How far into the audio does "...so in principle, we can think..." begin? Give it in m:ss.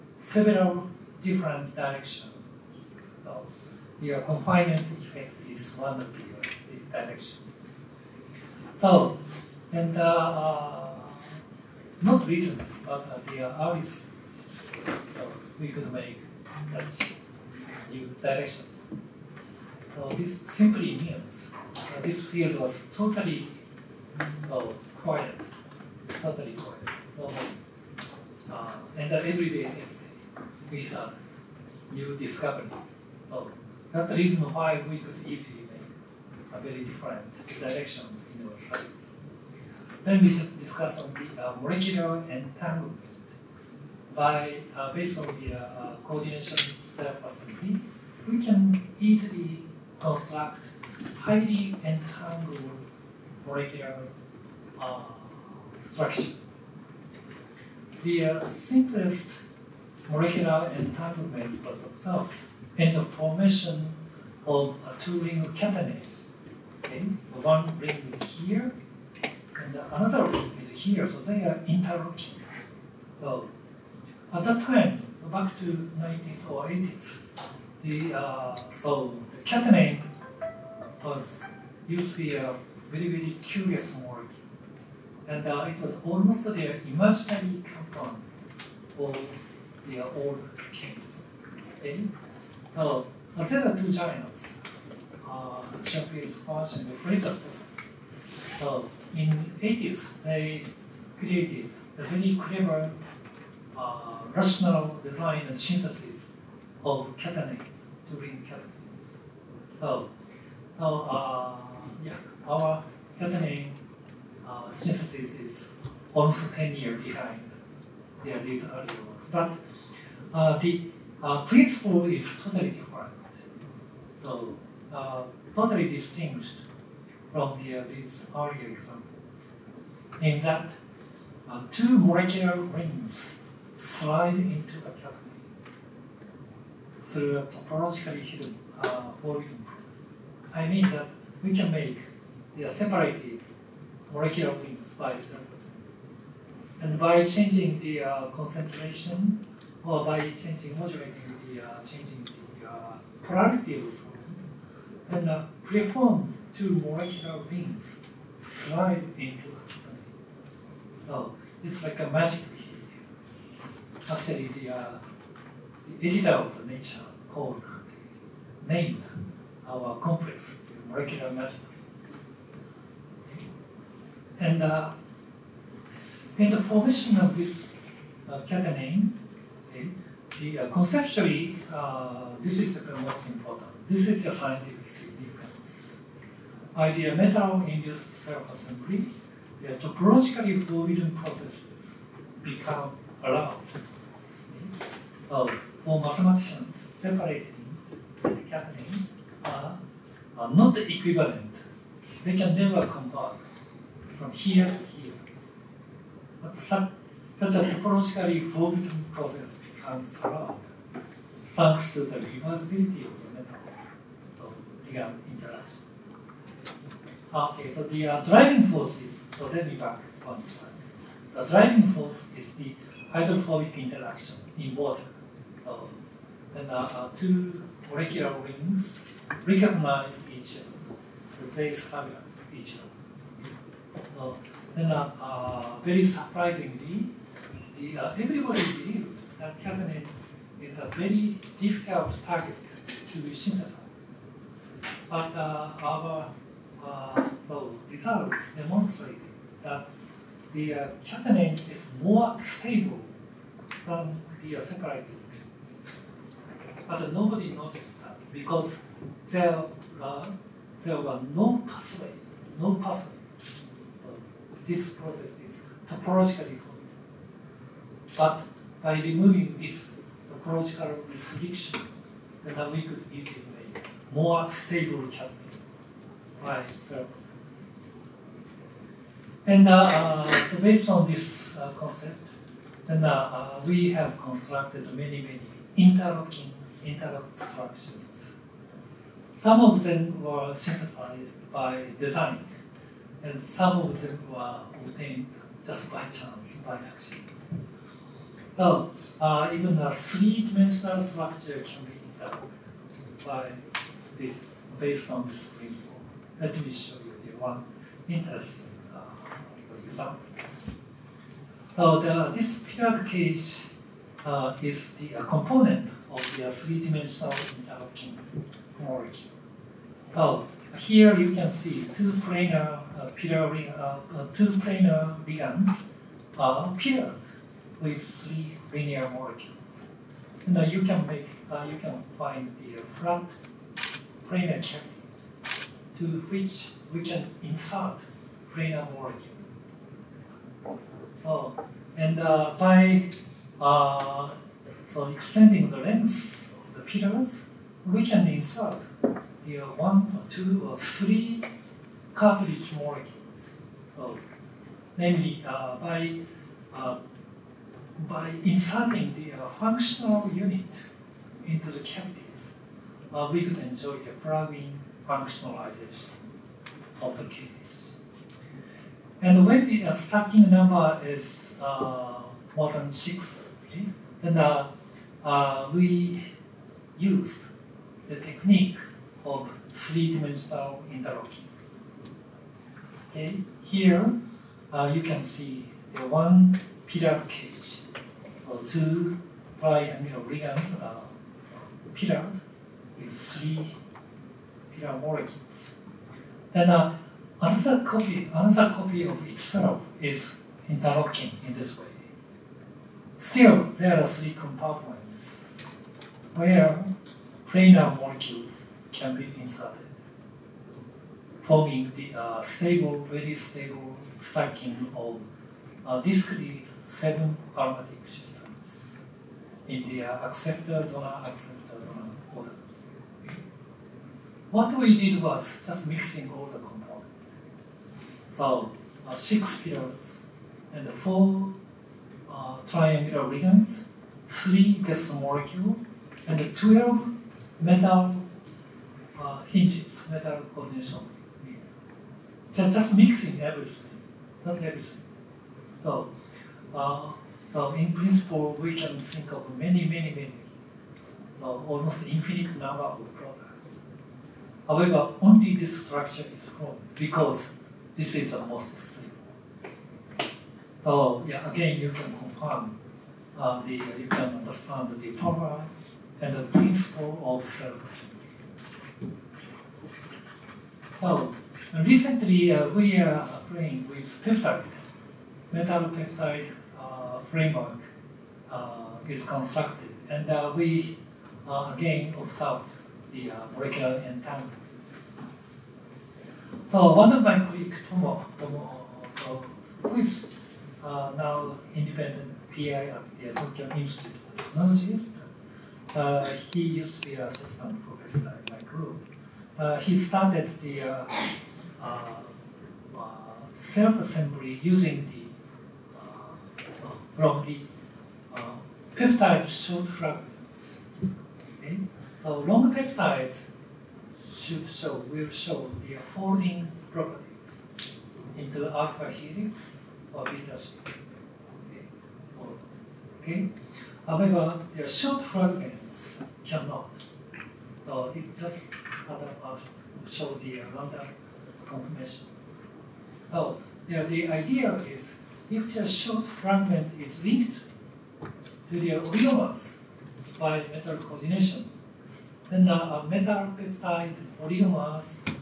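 7:27.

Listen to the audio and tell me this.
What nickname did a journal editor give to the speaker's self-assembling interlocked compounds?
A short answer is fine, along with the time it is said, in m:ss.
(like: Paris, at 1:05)
molecular magic rings, at 2:50.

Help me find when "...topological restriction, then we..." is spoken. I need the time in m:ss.
4:30.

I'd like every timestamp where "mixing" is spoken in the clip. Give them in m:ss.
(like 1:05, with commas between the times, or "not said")
7:05, 7:22.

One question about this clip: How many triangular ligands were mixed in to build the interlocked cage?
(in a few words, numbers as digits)
4.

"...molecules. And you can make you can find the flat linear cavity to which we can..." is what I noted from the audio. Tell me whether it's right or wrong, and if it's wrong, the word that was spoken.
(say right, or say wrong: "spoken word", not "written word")
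wrong: "planar", not "linear".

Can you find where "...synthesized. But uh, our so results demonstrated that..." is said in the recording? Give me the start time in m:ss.
4:03.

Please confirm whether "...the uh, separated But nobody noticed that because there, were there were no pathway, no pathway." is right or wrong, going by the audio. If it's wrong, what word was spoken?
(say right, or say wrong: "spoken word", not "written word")
right.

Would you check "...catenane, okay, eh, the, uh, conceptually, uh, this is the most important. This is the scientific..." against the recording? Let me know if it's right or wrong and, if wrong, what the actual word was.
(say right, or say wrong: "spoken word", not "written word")
right.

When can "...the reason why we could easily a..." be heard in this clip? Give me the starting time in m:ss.
0:34.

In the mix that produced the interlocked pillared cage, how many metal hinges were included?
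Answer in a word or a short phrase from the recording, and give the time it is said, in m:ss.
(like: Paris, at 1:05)
12, at 7:16.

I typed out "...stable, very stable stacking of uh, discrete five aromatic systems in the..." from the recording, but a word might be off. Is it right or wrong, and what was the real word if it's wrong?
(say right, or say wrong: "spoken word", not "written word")
wrong: "seven", not "five".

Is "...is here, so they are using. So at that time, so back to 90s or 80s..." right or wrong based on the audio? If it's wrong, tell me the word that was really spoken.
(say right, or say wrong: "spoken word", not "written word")
wrong: "interlocking", not "using".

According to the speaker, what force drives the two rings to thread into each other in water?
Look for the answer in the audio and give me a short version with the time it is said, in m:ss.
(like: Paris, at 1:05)
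hydrophobic interaction, at 3:43.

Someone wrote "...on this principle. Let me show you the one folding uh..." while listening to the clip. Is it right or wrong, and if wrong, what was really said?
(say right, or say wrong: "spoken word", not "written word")
wrong: "interesting", not "folding".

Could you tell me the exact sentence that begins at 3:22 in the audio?
They can never convert from here to here.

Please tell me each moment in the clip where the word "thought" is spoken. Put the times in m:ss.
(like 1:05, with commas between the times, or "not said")
not said.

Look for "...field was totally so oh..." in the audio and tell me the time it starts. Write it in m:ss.
0:22.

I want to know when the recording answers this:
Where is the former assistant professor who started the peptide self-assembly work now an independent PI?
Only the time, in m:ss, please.
8:13.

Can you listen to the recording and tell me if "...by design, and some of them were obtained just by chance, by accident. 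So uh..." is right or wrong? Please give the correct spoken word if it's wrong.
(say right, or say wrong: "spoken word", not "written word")
right.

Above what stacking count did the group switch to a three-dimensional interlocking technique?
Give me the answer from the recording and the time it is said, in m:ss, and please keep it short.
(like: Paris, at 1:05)
6, at 6:12.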